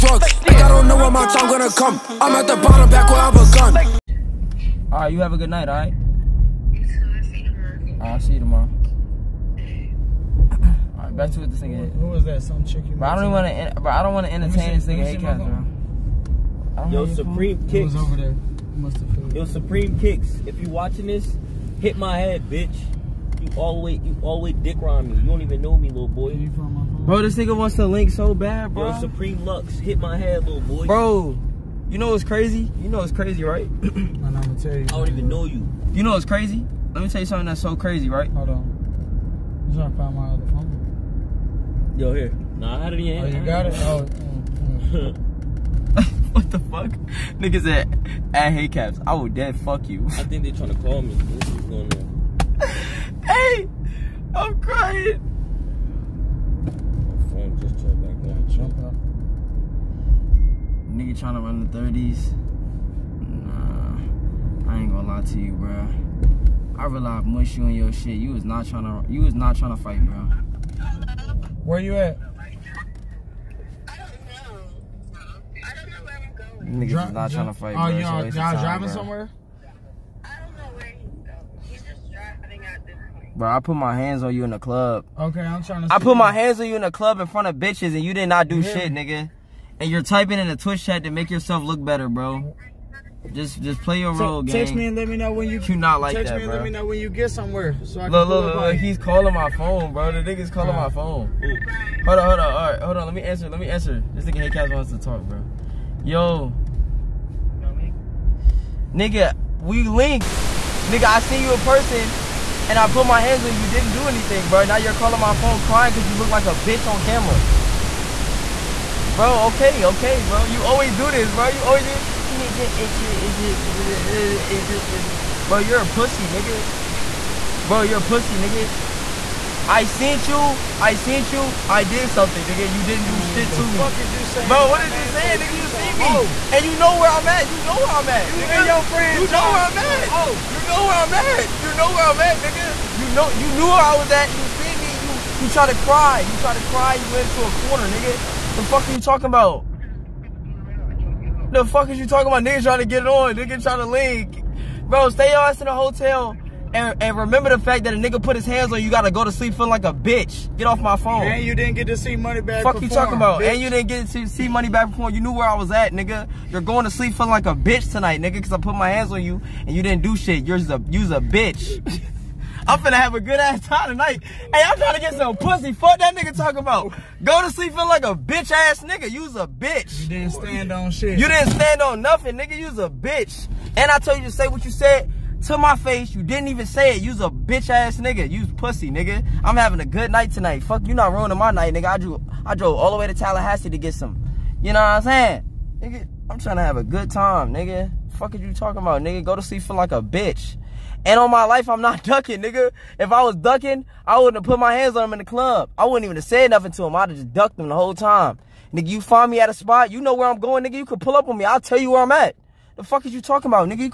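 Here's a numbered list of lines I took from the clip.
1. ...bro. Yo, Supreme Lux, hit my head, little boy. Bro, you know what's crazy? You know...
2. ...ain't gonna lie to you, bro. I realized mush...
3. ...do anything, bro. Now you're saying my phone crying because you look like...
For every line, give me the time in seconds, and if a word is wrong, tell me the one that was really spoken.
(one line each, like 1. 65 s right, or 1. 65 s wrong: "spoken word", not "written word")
1. 28 s right
2. 64 s right
3. 113 s wrong: "calling", not "saying".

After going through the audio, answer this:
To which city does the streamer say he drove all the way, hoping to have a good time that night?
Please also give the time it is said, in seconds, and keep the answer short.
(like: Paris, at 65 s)
Tallahassee, at 193 s.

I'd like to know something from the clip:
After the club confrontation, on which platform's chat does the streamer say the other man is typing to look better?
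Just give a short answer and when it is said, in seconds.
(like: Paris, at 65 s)
Twitch, at 90 s.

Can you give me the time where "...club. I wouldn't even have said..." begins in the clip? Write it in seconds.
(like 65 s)
205 s.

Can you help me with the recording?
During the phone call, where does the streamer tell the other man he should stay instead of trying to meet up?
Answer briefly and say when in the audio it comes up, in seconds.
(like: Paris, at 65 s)
The hotel, at 155 s.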